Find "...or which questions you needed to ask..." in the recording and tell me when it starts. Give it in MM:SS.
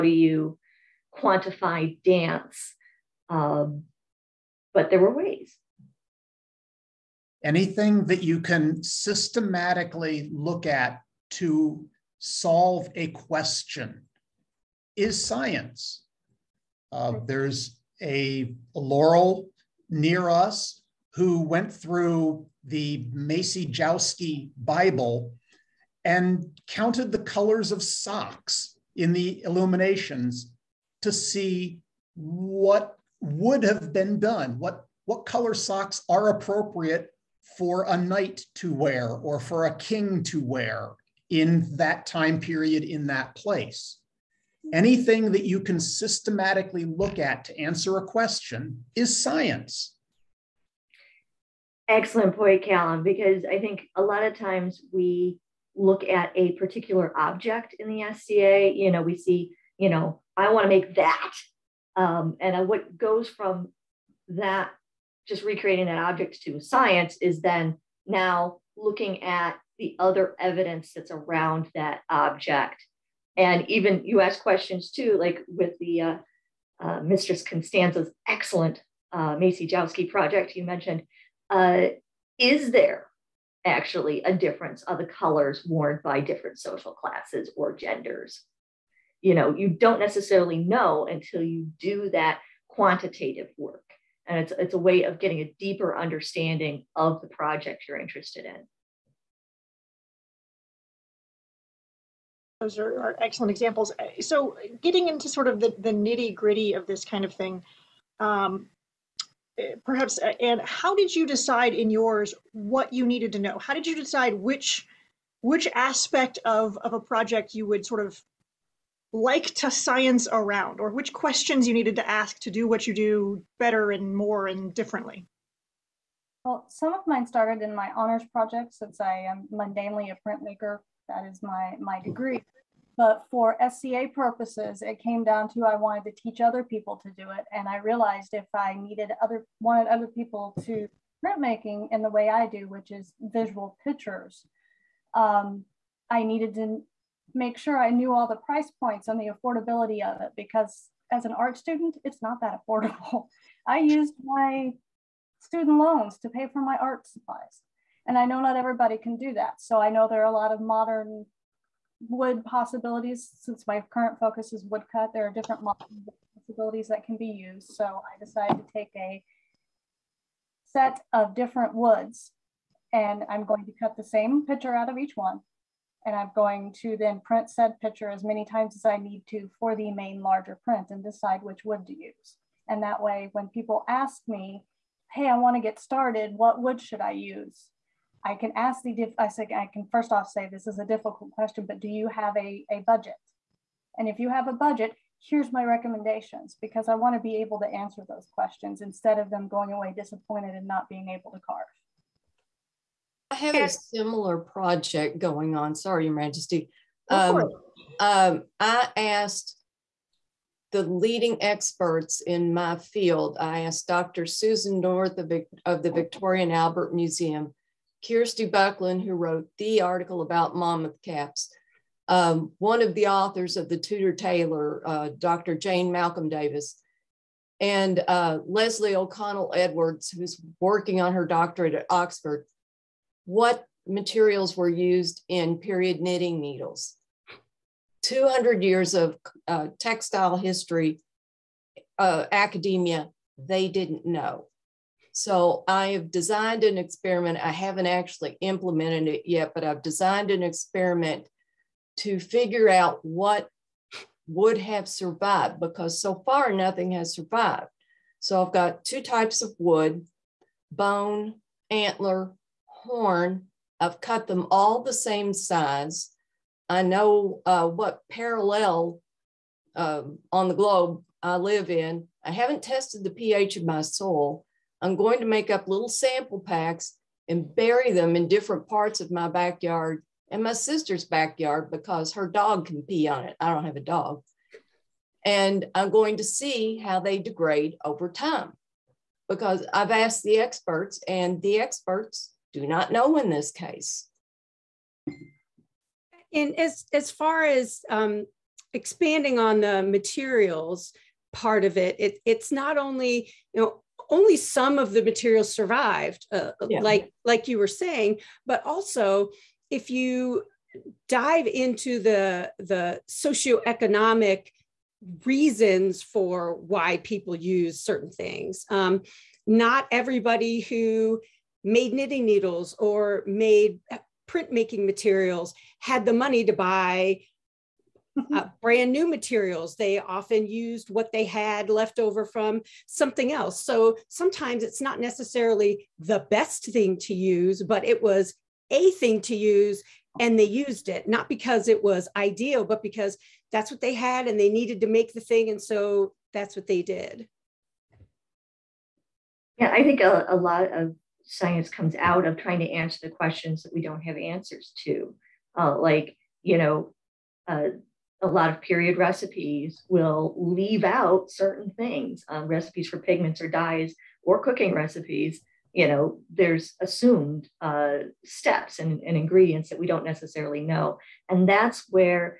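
02:00.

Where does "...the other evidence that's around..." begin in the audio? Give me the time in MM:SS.
01:09.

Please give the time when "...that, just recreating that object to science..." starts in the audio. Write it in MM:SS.
01:04.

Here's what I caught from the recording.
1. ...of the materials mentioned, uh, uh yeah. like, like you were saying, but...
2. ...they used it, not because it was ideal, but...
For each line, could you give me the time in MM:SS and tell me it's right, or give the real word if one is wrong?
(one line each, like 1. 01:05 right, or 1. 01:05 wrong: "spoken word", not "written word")
1. 05:04 wrong: "survived", not "mentioned"
2. 05:40 right.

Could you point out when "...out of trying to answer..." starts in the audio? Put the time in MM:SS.
05:51.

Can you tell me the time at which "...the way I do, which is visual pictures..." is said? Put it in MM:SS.
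02:22.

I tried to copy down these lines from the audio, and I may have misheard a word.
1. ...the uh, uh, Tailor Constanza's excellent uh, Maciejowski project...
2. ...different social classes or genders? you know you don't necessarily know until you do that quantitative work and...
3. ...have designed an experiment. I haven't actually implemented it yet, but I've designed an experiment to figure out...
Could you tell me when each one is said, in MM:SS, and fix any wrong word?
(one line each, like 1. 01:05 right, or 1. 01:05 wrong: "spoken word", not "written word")
1. 01:15 wrong: "Mistress", not "Tailor"
2. 01:26 right
3. 04:05 right.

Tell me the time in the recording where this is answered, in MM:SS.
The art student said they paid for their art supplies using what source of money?
02:35.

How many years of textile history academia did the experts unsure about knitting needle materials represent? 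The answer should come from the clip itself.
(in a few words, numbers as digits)
200.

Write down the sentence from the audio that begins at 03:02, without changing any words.
And that way, when people ask me, hey, I wanna get started, what wood should I use?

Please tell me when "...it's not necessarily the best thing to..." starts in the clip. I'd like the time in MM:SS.
05:34.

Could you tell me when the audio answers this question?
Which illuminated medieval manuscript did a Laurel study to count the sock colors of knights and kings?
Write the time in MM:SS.
00:23.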